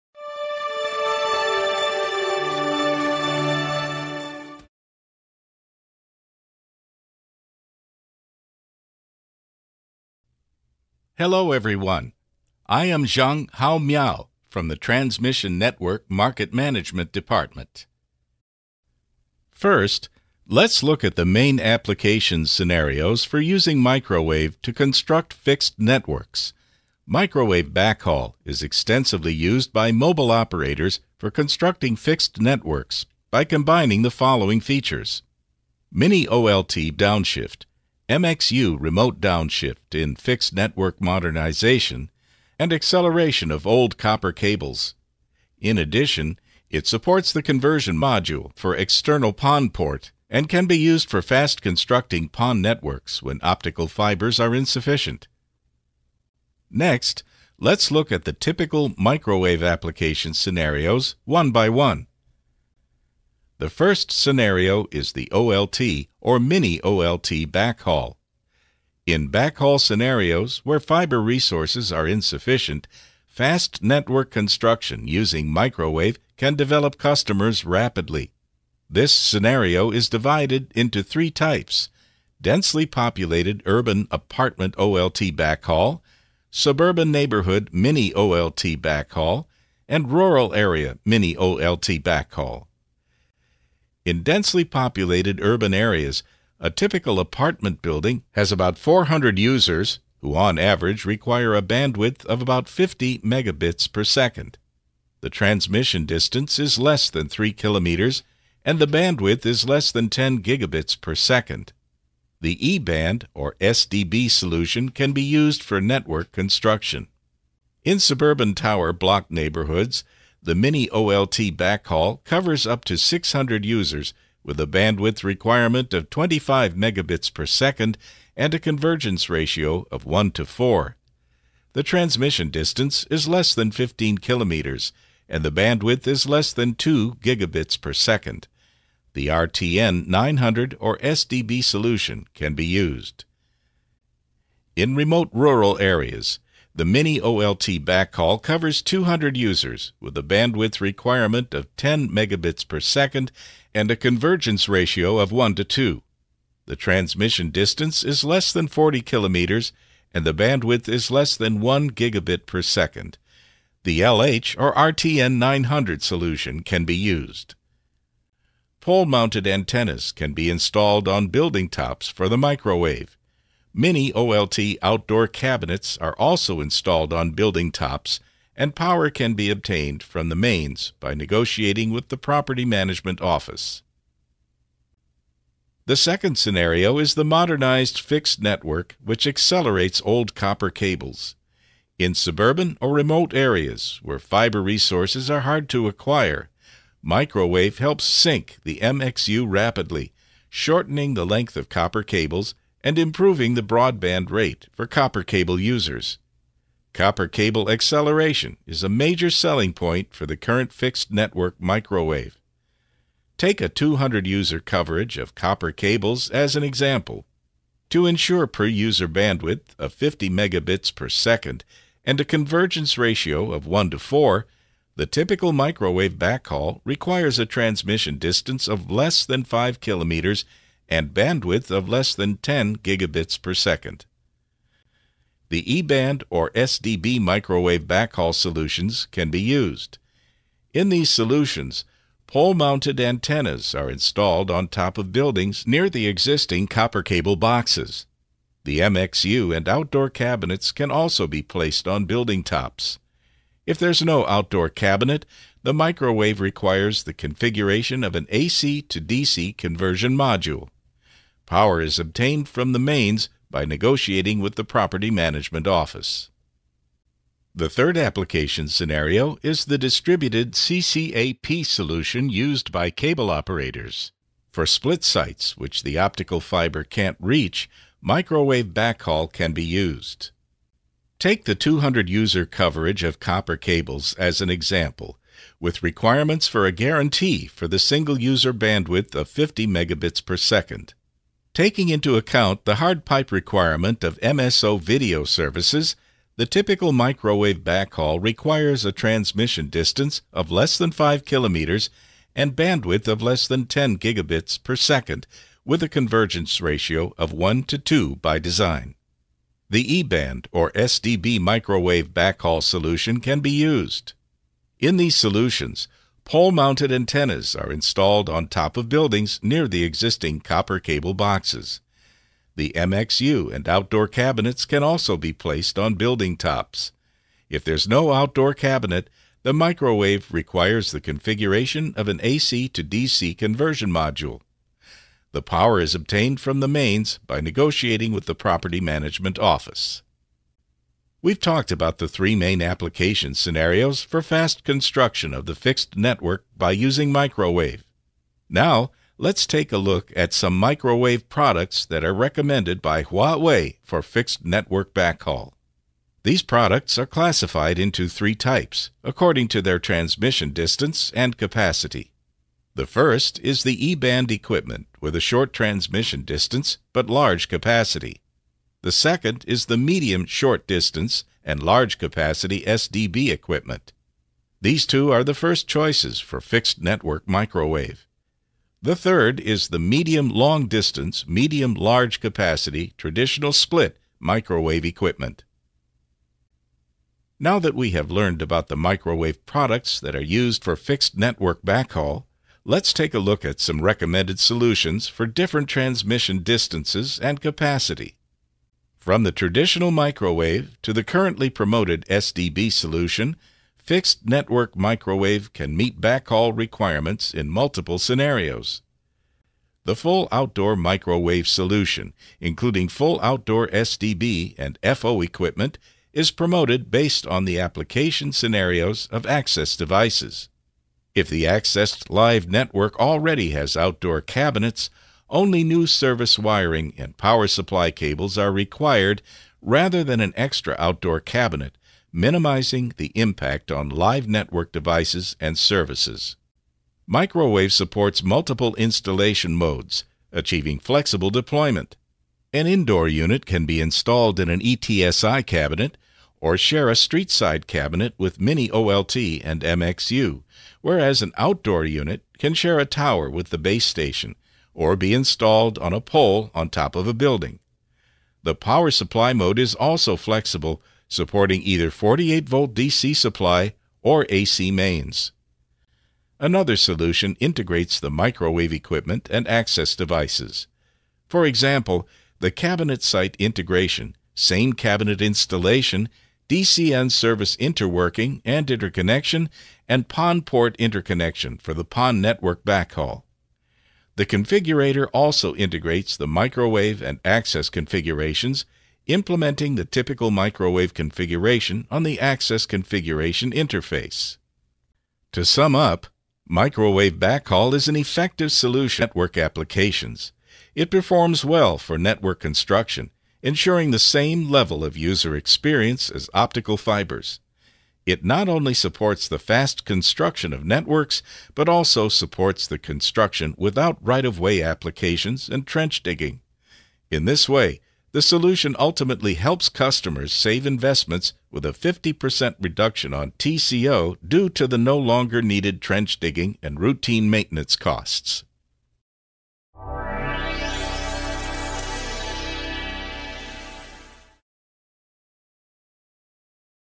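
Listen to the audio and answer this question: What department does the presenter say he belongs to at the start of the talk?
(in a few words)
Transmission Network Market Management Department.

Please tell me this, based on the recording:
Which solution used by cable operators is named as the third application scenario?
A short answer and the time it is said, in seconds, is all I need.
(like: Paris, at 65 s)
distributed CCAP, at 269 s.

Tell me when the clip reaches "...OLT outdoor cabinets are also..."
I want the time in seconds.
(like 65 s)
174 s.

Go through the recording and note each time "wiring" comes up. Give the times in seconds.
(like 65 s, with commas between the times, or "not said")
426 s.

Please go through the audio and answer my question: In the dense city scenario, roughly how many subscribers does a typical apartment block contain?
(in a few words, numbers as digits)
400.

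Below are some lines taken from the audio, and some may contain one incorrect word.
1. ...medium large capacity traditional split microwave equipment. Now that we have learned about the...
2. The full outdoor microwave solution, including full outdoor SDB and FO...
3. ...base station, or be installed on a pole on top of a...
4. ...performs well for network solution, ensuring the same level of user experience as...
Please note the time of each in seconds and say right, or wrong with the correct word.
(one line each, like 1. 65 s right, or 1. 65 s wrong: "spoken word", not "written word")
1. 381 s right
2. 409 s right
3. 453 s right
4. 500 s wrong: "construction", not "solution".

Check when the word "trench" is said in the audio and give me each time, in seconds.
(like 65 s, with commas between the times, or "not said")
515 s, 525 s.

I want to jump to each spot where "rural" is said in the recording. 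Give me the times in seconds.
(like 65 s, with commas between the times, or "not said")
90 s, 145 s.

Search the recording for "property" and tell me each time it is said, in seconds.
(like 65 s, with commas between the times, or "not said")
182 s, 264 s, 338 s.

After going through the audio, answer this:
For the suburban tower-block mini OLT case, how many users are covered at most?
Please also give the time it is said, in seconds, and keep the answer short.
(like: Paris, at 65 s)
600, at 122 s.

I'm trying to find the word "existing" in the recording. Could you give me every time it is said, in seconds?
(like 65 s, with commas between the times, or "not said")
246 s, 319 s.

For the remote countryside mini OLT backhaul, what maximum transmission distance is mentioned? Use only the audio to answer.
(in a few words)
40 kilometers.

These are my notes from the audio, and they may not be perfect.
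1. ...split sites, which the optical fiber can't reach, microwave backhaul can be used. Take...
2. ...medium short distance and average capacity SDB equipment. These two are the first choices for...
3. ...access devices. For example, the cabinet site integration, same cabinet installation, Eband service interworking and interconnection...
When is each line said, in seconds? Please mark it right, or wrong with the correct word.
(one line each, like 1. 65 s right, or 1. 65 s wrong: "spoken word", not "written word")
1. 274 s right
2. 369 s wrong: "large", not "average"
3. 469 s wrong: "DCN", not "Eband".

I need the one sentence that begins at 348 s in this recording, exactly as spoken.
Now, let's take a look at some microwave products that are recommended by Huawei for fixed network backhaul.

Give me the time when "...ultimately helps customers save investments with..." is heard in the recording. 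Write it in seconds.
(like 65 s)
518 s.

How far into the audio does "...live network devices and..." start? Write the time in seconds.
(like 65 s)
433 s.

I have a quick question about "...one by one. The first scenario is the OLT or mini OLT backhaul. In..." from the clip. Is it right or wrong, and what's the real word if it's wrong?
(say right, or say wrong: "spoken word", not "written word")
right.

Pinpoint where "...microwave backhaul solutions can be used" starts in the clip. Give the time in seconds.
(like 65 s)
237 s.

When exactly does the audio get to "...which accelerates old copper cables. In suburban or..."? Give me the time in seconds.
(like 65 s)
189 s.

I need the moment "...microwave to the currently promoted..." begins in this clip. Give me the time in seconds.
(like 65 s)
399 s.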